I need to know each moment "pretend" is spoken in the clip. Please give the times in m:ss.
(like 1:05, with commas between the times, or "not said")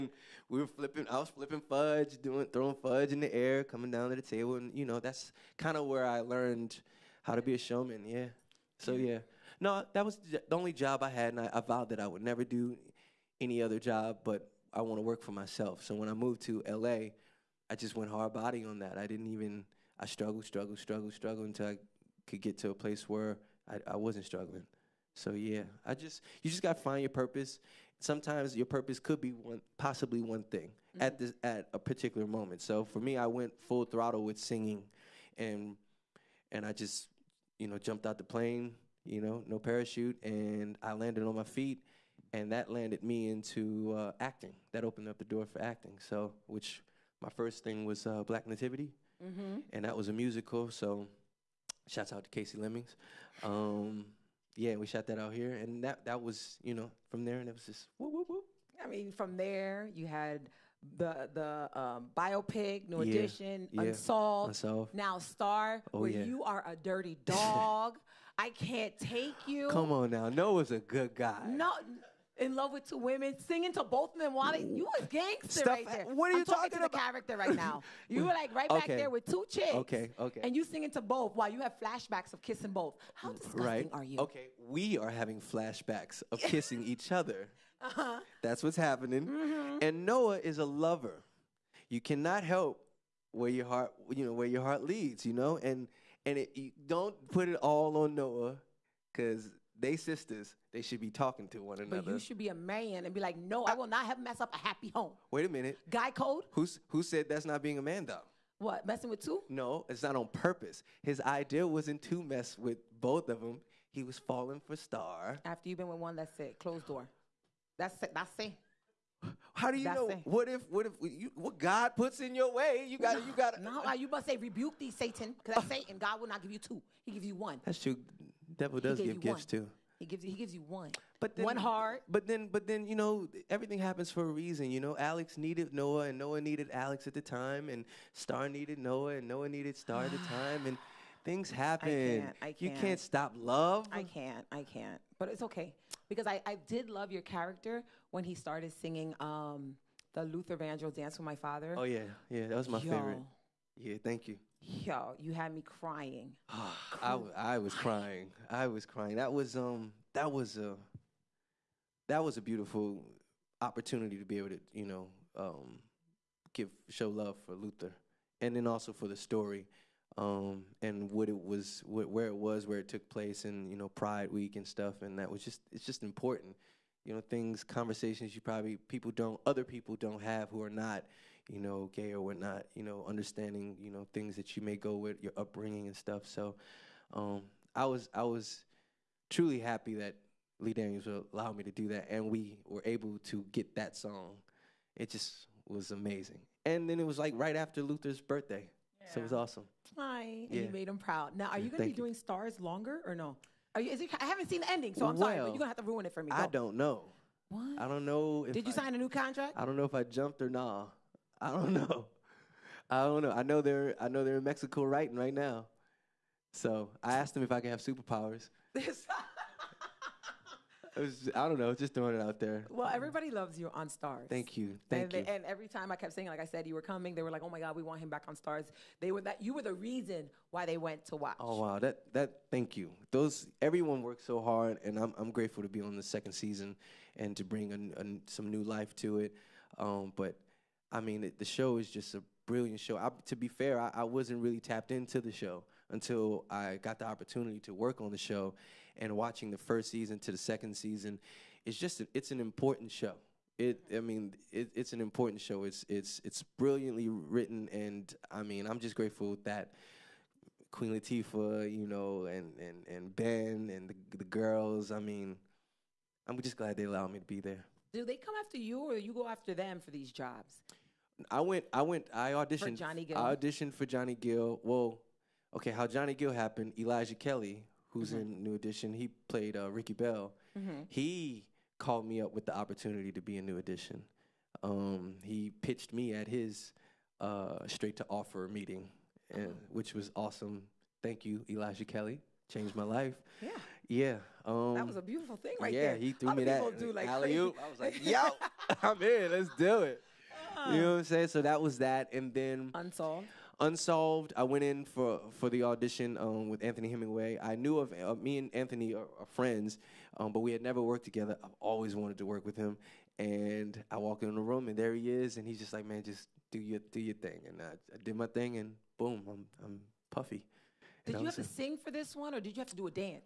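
not said.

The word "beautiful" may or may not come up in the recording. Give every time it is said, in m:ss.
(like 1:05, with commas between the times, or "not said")
2:42, 4:55.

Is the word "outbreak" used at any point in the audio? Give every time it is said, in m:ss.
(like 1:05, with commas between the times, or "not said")
not said.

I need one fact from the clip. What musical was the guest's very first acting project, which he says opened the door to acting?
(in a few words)
Black Nativity.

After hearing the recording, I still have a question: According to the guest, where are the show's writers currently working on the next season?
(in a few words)
Mexico.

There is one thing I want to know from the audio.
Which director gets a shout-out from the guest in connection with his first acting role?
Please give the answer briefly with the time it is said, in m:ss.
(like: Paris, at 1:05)
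Kasi Lemmons, at 0:52.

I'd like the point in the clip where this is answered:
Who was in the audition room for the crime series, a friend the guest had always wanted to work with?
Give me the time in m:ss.
5:06.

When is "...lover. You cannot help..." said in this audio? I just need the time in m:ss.
1:30.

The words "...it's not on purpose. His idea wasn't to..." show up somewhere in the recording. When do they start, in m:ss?
1:49.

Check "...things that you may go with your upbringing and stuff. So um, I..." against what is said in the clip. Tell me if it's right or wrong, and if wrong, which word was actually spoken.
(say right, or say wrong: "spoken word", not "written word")
right.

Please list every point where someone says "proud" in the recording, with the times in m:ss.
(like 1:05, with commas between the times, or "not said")
3:20.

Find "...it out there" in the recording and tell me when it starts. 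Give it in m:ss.
3:42.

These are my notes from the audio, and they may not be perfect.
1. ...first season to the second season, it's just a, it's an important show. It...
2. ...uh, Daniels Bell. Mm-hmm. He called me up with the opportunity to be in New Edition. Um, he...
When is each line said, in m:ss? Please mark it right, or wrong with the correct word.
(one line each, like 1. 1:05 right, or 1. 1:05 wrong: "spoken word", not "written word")
1. 4:09 right
2. 4:39 wrong: "Ricky", not "Daniels".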